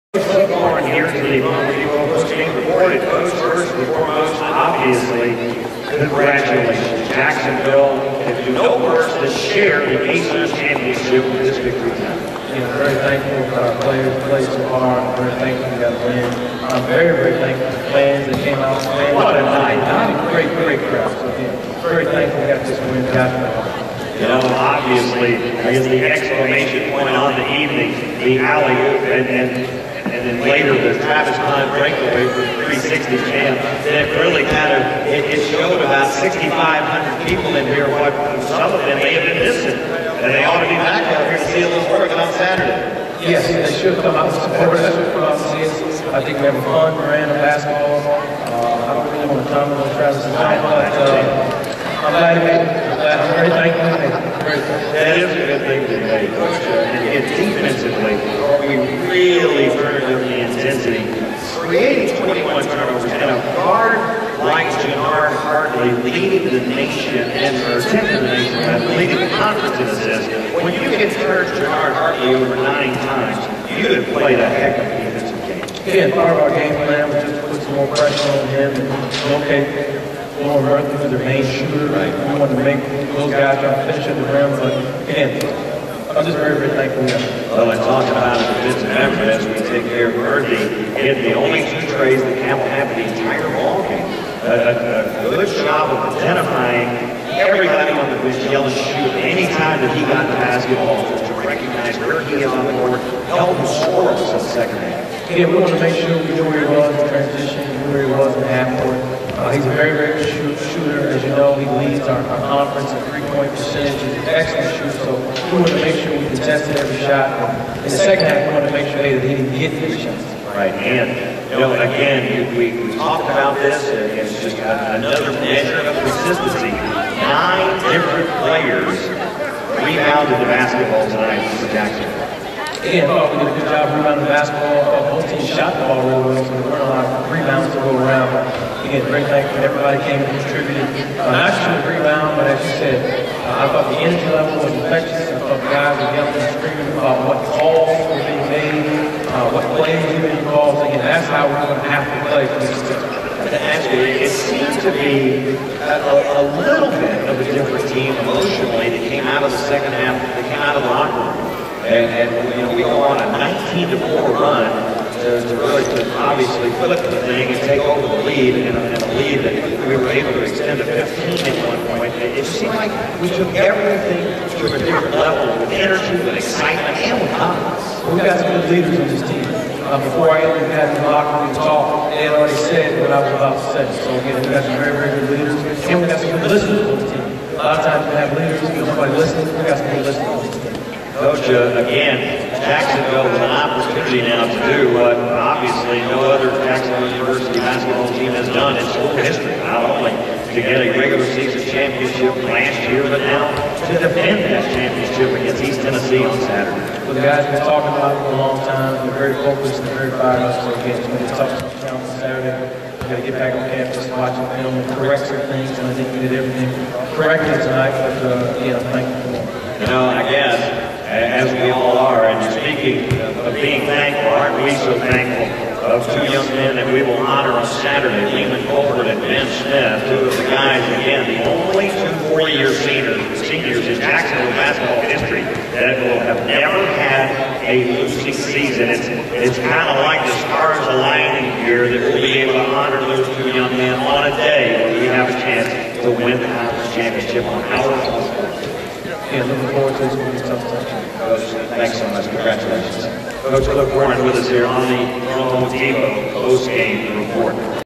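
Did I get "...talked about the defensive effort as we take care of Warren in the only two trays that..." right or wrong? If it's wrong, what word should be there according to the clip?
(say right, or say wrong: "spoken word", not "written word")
wrong: "Ernie", not "Warren".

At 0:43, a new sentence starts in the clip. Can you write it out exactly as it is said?
Yes, they should come out and support us.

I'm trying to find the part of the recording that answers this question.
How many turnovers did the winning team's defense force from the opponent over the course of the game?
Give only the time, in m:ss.
1:02.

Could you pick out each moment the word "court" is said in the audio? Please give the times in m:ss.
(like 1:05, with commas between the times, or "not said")
1:42, 1:48.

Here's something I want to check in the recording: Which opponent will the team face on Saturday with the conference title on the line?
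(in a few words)
East Tennessee.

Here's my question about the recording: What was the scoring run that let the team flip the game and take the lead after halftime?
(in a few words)
19 to 4.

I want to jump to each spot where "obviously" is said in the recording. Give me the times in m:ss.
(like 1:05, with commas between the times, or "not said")
0:04, 0:24, 2:46, 3:15.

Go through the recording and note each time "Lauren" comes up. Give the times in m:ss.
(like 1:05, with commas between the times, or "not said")
0:00, 1:20.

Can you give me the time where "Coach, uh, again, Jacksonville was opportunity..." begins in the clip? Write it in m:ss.
3:11.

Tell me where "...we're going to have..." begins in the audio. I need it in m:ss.
2:31.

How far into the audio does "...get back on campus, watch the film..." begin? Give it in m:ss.
3:33.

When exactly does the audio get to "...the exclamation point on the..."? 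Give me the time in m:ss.
0:25.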